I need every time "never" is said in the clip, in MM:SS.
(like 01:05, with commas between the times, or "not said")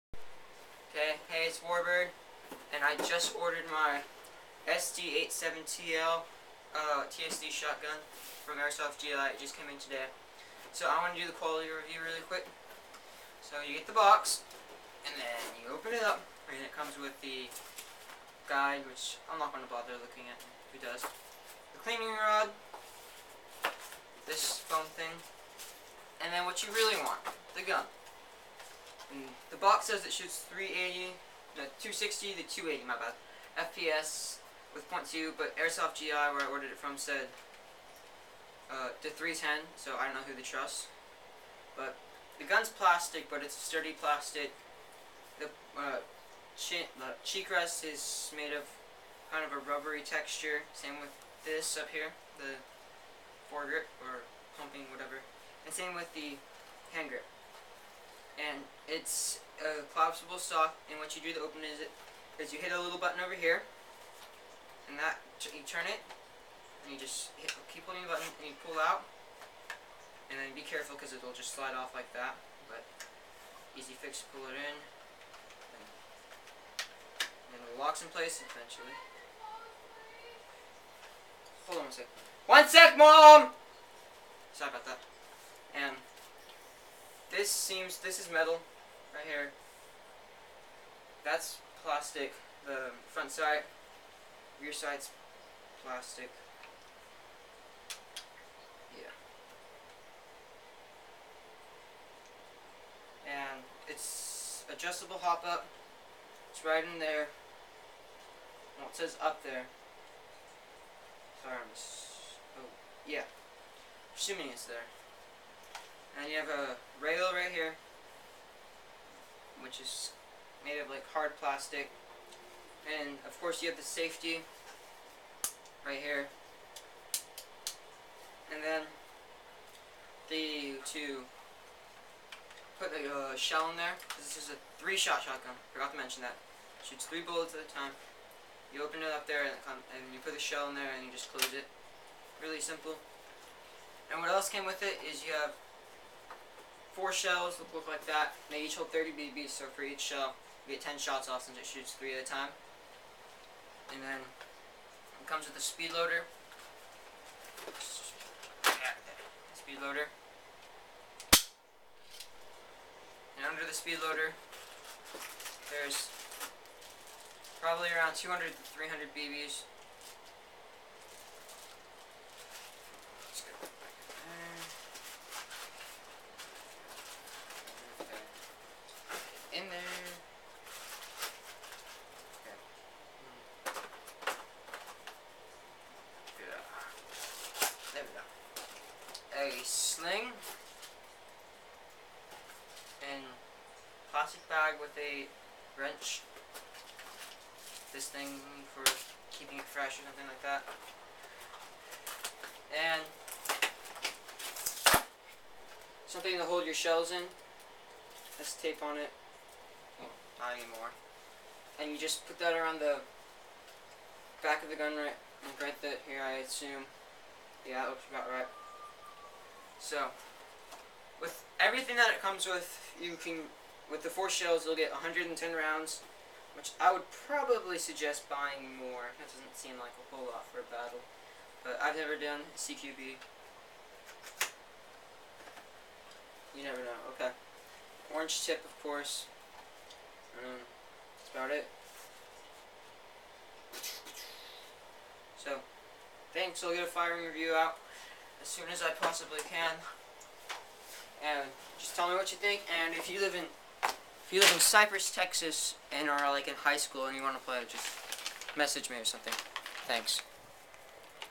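03:51, 03:56.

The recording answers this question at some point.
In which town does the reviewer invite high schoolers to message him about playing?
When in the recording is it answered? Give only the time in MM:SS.
04:14.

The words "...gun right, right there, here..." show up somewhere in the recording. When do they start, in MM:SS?
03:34.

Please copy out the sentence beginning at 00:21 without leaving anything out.
The cleaning rod, this foam thing, and then what you really want, the gun.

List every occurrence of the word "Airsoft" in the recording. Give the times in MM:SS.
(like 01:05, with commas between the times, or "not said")
00:08, 00:35.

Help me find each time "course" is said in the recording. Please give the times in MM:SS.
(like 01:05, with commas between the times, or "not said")
02:03, 03:58.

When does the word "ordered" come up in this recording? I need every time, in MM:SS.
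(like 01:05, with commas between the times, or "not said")
00:03, 00:36.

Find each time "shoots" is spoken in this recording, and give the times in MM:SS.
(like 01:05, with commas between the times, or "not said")
00:30, 02:16, 02:31.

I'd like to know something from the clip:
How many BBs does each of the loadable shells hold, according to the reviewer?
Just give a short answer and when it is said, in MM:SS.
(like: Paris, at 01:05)
30, at 02:28.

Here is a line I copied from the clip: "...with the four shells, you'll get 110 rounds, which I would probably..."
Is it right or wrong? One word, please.
right.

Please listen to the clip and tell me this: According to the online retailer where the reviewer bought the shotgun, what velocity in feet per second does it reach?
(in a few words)
310.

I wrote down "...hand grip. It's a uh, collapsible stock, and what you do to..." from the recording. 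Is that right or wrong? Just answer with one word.
right.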